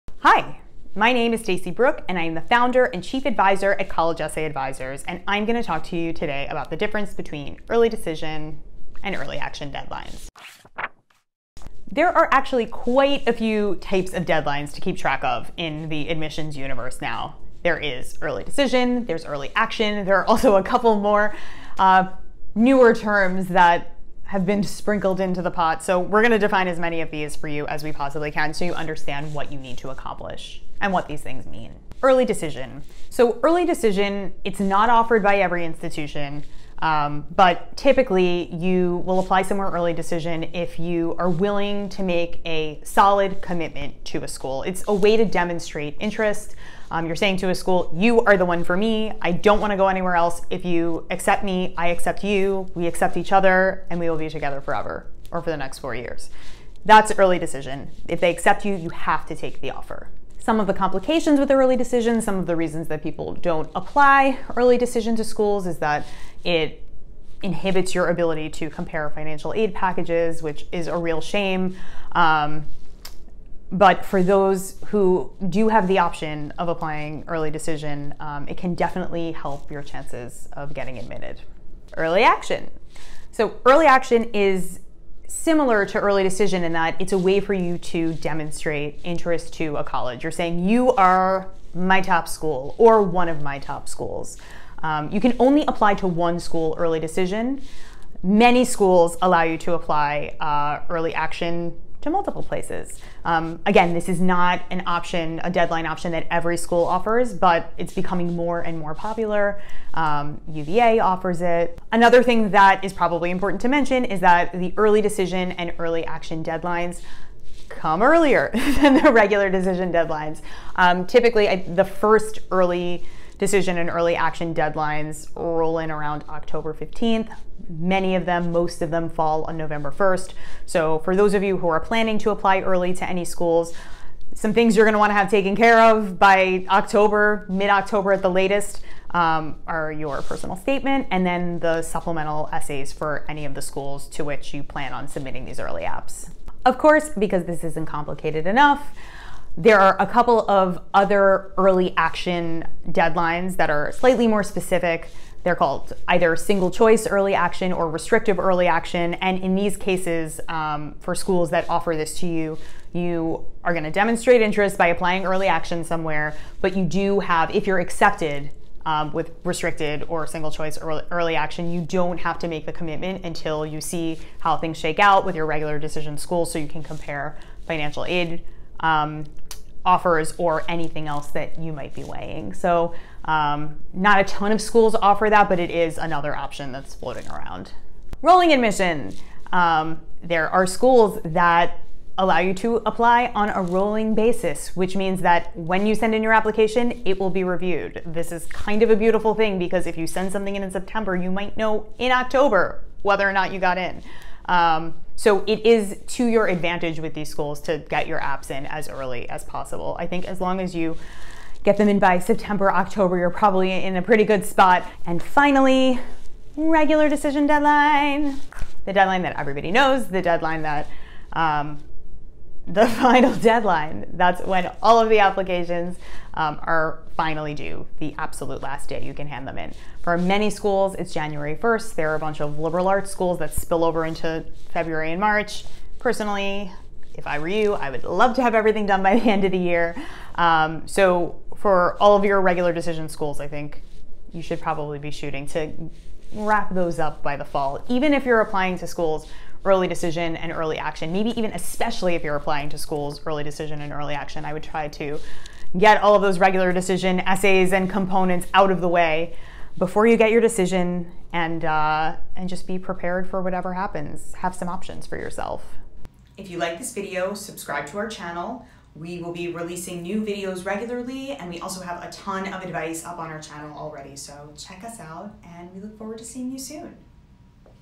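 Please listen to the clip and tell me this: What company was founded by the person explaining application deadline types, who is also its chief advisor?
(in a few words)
College Essay Advisors.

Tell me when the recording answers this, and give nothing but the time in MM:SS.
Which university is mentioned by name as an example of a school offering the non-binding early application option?
01:50.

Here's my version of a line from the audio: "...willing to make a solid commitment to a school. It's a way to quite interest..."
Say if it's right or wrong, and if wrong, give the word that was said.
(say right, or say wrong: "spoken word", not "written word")
wrong: "demonstrate", not "quite".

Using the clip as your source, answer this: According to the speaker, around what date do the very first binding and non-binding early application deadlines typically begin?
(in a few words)
October 15th.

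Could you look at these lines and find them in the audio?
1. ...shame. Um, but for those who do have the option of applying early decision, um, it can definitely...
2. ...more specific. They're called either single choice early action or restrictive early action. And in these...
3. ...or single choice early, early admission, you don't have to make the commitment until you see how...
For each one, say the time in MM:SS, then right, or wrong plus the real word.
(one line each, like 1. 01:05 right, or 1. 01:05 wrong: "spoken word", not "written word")
1. 01:11 right
2. 02:34 right
3. 02:50 wrong: "action", not "admission".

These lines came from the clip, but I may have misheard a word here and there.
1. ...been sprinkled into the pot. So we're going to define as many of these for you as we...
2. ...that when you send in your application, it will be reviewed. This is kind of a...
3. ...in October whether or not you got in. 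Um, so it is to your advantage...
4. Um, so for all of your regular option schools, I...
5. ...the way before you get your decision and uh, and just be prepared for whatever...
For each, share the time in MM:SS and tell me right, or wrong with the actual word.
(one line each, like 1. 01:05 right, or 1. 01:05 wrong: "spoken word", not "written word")
1. 00:24 right
2. 03:15 right
3. 03:21 right
4. 04:00 wrong: "decision", not "option"
5. 04:18 right.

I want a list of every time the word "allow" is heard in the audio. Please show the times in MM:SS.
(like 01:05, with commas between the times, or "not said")
01:39, 03:12.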